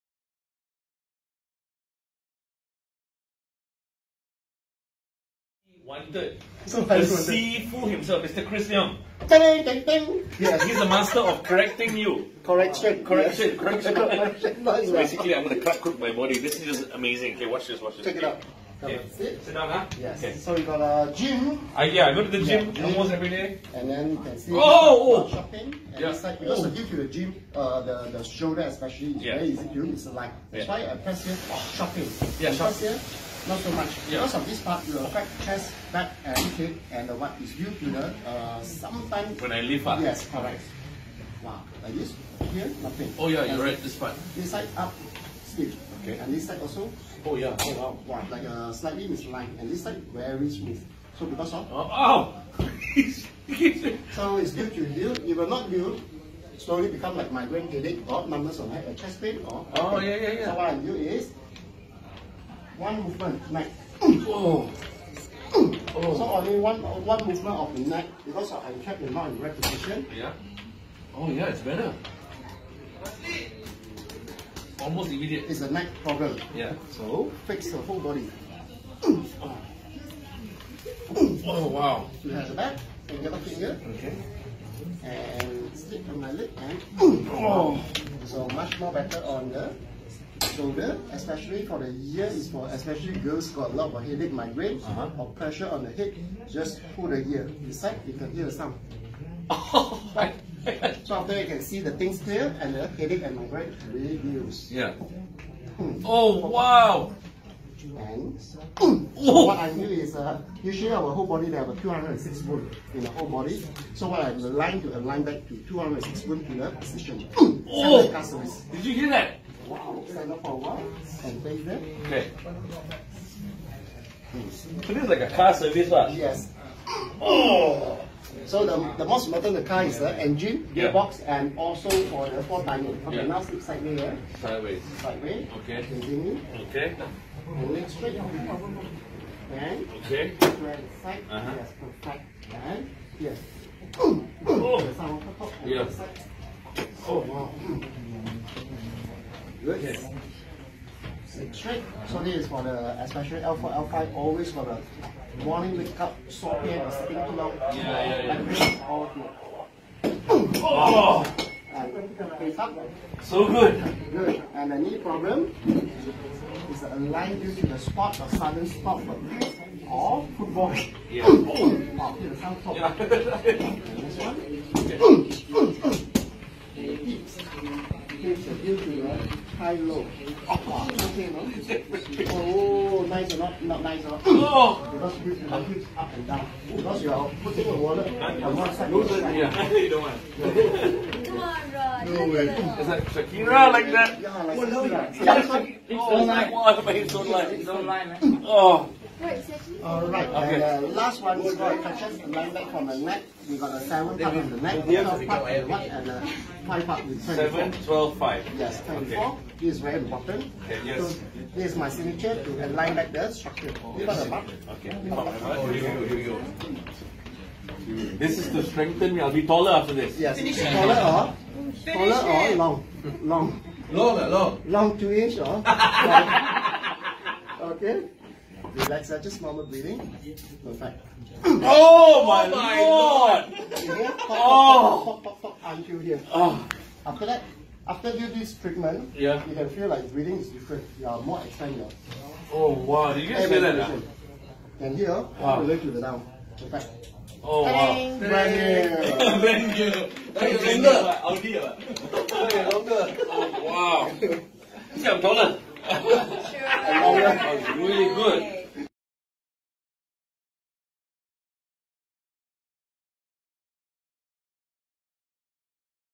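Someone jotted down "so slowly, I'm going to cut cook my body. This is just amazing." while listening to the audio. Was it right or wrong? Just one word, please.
wrong.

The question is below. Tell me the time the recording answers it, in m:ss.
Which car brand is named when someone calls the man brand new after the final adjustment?
4:11.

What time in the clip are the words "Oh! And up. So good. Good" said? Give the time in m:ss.
2:40.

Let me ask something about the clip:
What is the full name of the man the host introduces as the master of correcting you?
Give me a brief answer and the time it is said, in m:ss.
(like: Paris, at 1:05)
Chris Leong, at 0:08.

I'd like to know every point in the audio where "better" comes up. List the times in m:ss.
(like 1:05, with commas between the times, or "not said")
1:11, 1:28.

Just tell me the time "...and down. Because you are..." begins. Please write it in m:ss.
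3:06.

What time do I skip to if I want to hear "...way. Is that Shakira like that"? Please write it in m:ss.
3:12.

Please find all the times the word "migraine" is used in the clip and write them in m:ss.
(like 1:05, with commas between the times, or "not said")
0:57, 1:34, 1:43.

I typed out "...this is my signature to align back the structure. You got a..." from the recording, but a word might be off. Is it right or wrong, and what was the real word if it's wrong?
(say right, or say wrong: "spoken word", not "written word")
right.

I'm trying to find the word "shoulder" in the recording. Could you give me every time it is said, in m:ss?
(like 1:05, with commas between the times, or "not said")
0:28, 1:30.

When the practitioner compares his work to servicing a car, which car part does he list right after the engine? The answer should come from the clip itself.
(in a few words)
Gearbox.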